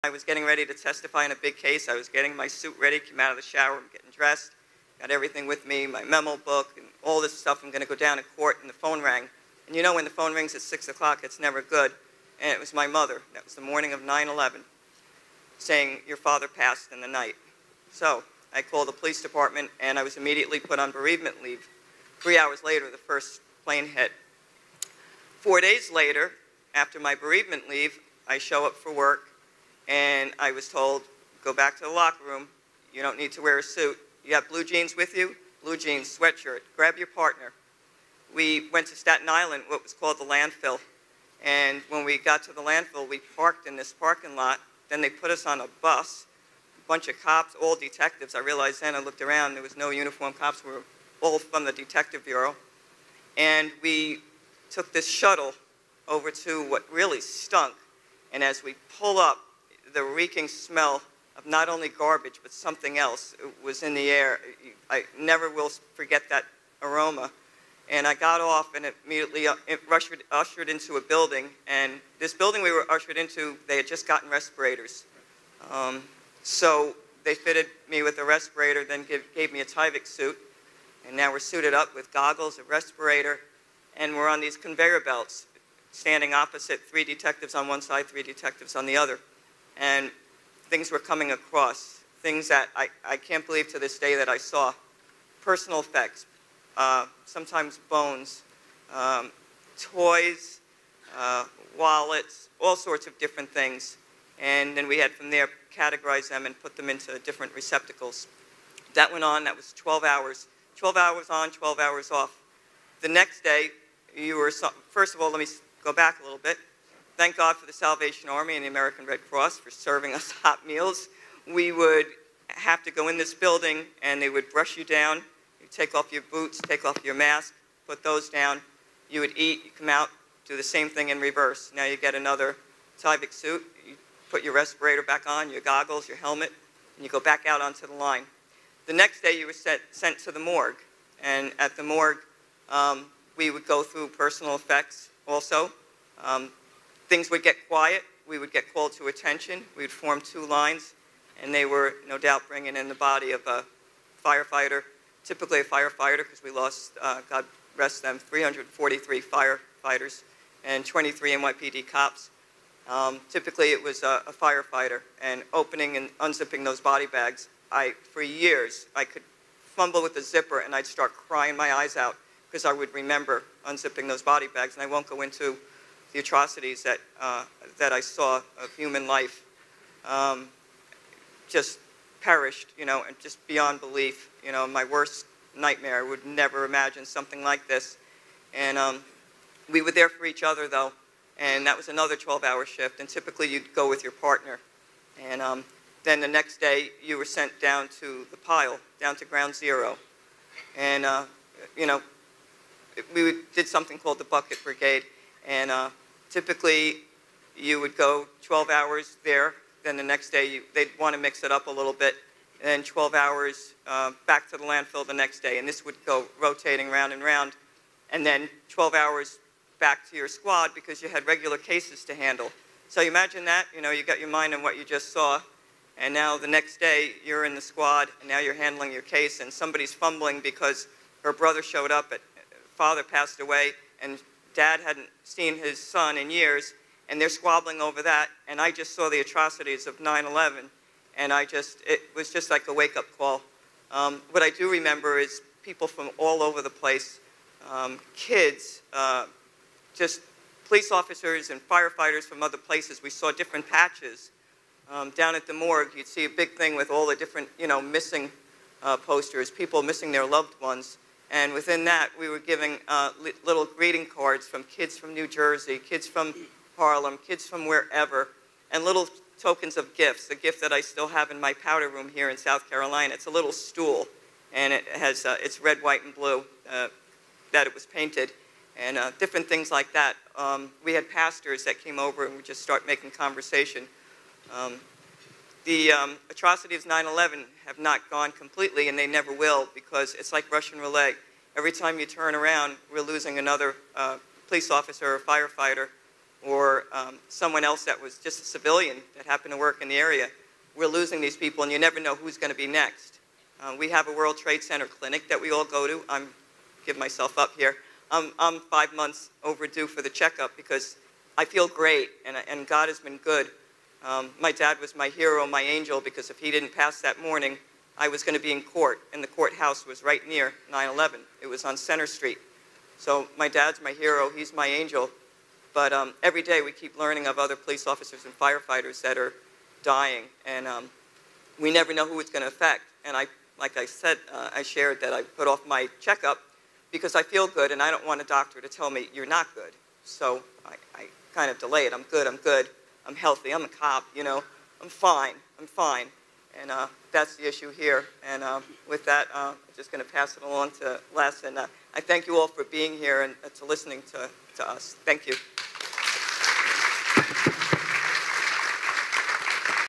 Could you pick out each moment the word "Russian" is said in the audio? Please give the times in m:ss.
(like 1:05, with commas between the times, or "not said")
4:50.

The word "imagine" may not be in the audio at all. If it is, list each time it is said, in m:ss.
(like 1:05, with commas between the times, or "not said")
3:06, 3:43.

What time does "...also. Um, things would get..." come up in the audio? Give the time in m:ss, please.
2:25.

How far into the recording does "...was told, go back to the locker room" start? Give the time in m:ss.
0:30.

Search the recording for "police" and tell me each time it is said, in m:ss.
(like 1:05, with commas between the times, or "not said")
0:18, 4:10, 4:54, 5:27.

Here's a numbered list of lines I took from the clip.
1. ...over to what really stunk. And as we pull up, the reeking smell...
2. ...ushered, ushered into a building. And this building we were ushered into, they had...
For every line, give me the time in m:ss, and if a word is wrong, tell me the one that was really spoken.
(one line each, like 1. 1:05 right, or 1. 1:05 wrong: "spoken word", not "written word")
1. 0:56 right
2. 1:09 right.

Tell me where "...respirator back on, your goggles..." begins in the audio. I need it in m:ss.
2:14.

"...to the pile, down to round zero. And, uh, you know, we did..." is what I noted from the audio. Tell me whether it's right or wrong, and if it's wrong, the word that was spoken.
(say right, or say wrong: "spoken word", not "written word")
wrong: "ground", not "round".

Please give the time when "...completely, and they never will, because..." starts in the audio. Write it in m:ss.
4:48.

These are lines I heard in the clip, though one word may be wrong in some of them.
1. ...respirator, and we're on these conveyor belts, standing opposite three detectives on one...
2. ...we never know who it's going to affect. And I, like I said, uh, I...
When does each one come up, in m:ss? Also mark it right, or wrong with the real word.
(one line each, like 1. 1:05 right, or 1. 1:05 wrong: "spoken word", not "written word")
1. 1:22 right
2. 5:31 right.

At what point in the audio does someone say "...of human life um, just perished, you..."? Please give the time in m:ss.
2:58.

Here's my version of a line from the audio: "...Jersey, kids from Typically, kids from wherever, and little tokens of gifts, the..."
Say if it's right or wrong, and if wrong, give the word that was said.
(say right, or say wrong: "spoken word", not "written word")
wrong: "Harlem", not "Typically".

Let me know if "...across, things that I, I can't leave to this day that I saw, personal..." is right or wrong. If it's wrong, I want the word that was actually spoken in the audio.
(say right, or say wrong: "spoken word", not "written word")
wrong: "believe", not "leave".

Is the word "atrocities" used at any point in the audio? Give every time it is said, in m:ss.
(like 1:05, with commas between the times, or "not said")
2:56, 3:59, 4:46.